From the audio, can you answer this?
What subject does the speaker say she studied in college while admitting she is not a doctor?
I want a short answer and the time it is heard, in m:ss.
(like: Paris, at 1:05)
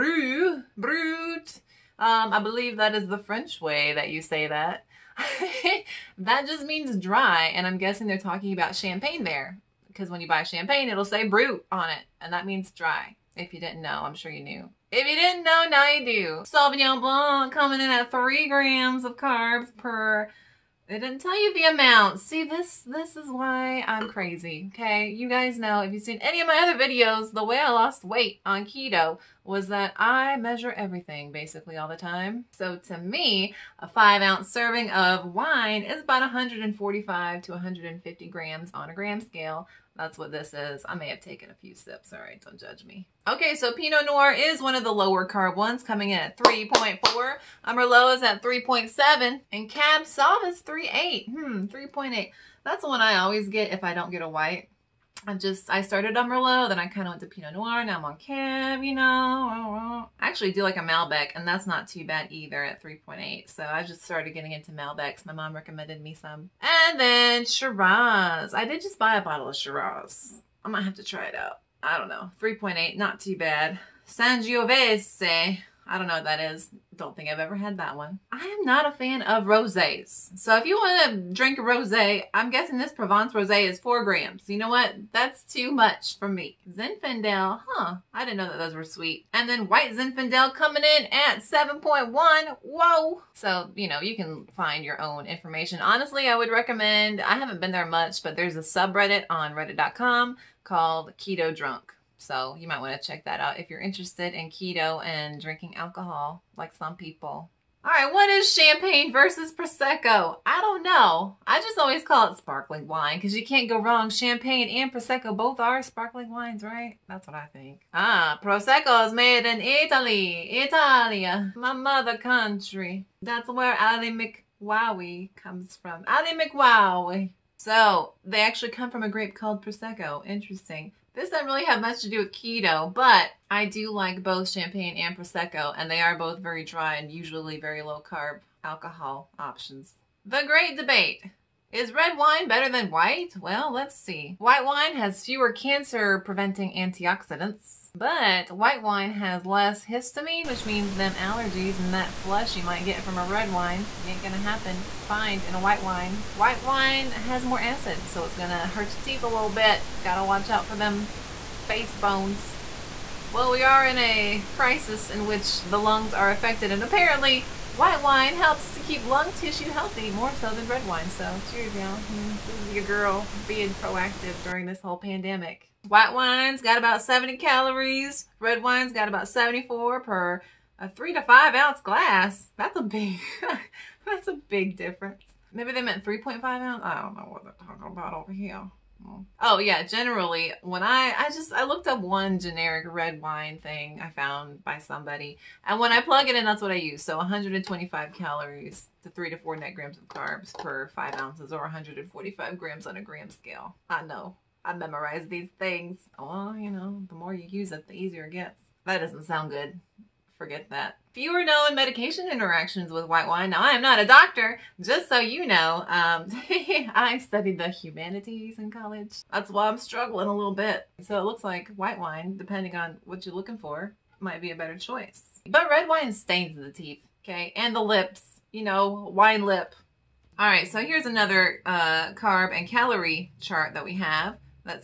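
the humanities, at 3:37.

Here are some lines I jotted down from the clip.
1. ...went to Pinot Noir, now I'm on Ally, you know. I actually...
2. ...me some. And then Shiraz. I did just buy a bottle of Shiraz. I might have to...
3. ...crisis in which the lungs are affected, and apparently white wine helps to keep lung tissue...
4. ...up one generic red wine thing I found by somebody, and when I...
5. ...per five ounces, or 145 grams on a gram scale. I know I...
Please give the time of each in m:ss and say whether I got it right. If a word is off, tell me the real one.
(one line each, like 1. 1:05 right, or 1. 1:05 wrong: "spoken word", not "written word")
1. 0:57 wrong: "Cab", not "Ally"
2. 1:06 right
3. 2:44 right
4. 3:11 right
5. 3:20 right.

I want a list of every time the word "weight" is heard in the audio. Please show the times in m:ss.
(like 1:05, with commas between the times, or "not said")
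0:28.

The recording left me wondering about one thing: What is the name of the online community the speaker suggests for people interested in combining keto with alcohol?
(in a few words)
Keto Drunk.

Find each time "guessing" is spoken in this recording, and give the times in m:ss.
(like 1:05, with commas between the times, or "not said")
0:07, 1:22.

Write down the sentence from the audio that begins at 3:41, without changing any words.
So it looks like white wine, depending on what you're looking for, might be a better choice.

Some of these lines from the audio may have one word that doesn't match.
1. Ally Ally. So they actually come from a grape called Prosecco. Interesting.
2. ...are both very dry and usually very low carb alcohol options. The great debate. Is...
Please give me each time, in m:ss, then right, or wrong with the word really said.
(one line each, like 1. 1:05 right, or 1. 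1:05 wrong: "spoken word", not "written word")
1. 2:06 wrong: "McWowie", not "Ally"
2. 2:16 right.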